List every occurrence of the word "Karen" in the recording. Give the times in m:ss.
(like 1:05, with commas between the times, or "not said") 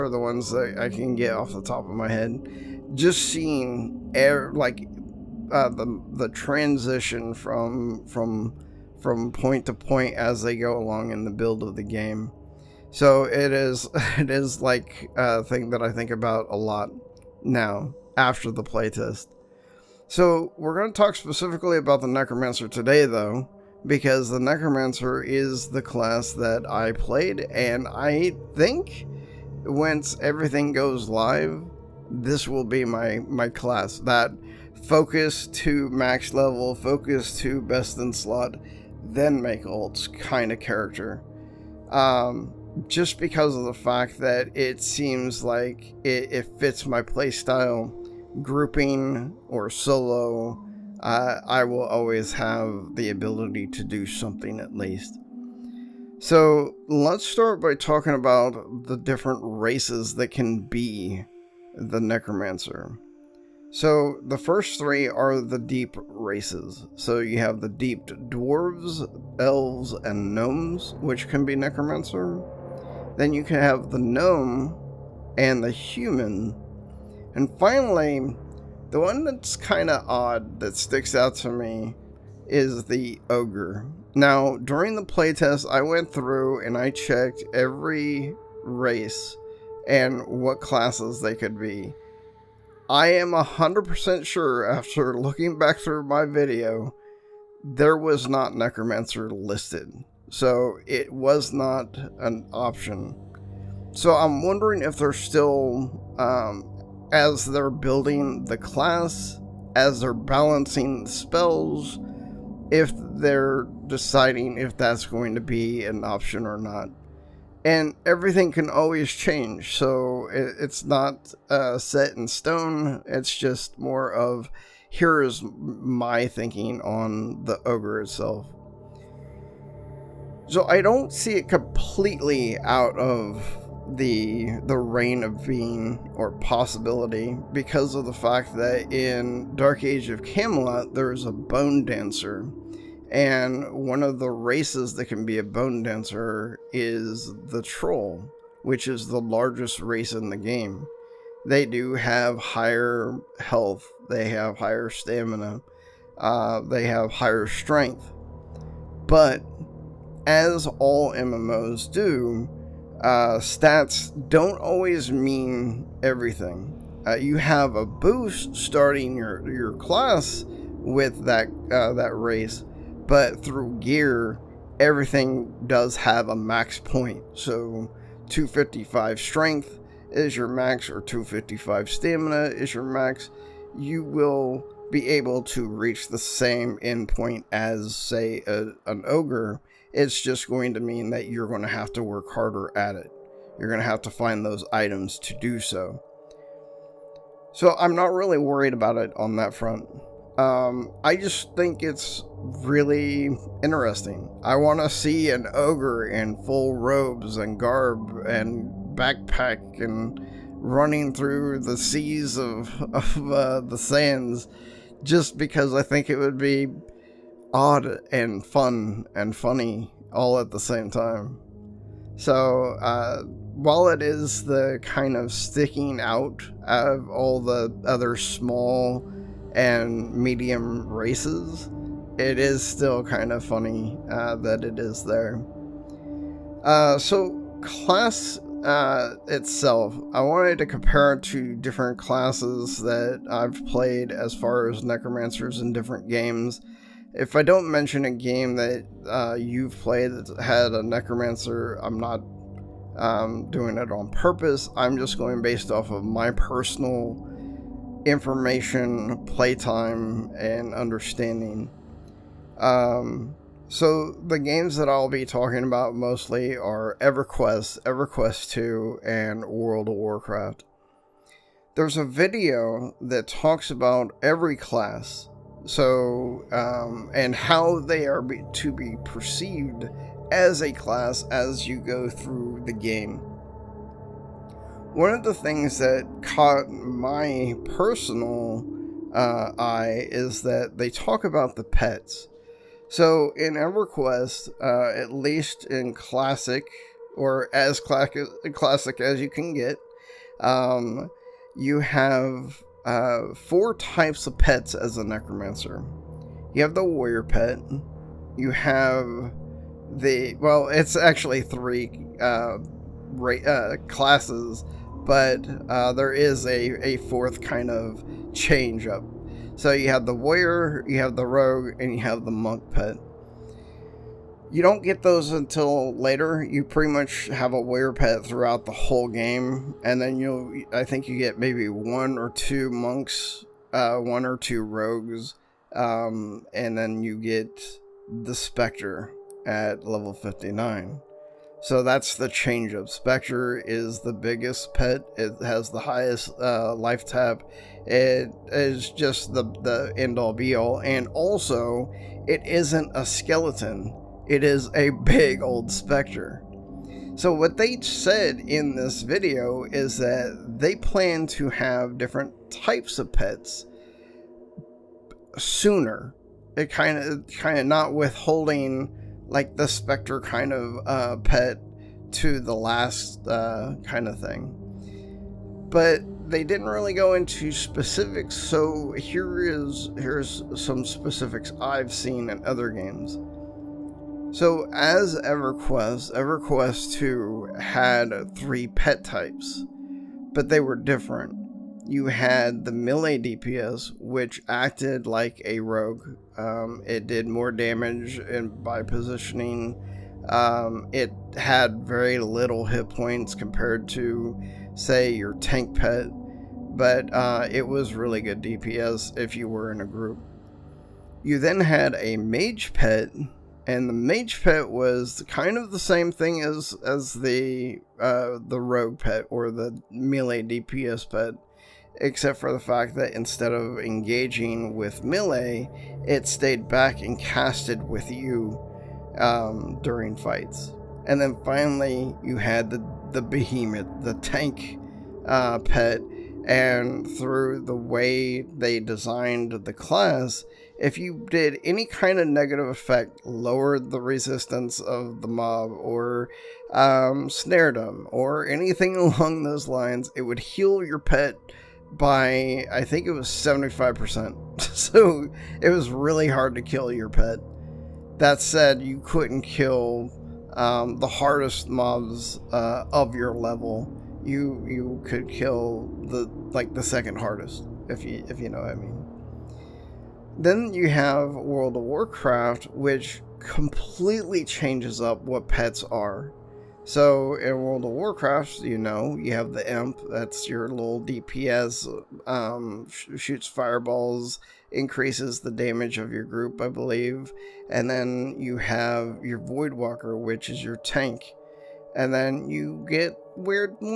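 not said.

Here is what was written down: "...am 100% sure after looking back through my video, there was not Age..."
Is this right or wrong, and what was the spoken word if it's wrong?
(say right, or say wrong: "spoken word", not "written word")
wrong: "Necromancer", not "Age".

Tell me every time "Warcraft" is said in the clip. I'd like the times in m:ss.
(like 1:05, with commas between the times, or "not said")
4:29, 7:51, 7:57.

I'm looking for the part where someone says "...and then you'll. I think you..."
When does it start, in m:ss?
5:29.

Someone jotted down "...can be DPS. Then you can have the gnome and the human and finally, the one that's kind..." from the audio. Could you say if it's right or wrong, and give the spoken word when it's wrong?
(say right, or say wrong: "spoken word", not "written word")
wrong: "Necromancer", not "DPS".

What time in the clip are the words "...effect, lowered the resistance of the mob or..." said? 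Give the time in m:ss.
7:22.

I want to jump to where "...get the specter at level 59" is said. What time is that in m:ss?
5:37.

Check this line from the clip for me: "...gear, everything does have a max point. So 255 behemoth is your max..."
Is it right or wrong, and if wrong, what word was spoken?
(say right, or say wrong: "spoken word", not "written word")
wrong: "strength", not "behemoth".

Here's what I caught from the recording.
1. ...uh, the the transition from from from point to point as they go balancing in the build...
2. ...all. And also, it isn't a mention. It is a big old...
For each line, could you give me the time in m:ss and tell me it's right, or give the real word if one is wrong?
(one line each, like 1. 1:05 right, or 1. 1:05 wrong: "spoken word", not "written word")
1. 0:05 wrong: "along", not "balancing"
2. 5:50 wrong: "skeleton", not "mention".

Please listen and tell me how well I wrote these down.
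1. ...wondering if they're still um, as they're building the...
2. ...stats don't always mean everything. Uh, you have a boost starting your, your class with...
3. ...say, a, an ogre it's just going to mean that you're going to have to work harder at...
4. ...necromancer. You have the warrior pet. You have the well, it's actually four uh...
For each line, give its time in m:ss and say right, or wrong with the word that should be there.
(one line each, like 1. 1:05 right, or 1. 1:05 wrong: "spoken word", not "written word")
1. 1:44 right
2. 2:43 right
3. 3:07 right
4. 5:05 wrong: "three", not "four".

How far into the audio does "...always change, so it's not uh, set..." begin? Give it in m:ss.
1:58.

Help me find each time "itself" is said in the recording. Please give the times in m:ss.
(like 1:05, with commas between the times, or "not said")
2:08, 3:59.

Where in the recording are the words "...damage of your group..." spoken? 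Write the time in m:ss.
8:05.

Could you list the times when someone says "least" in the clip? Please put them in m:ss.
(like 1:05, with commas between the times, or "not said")
0:54, 4:55.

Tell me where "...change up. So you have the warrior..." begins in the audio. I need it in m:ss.
5:18.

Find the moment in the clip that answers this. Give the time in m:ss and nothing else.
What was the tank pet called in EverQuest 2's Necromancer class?
7:13.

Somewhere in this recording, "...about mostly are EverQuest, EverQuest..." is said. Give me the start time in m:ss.
4:25.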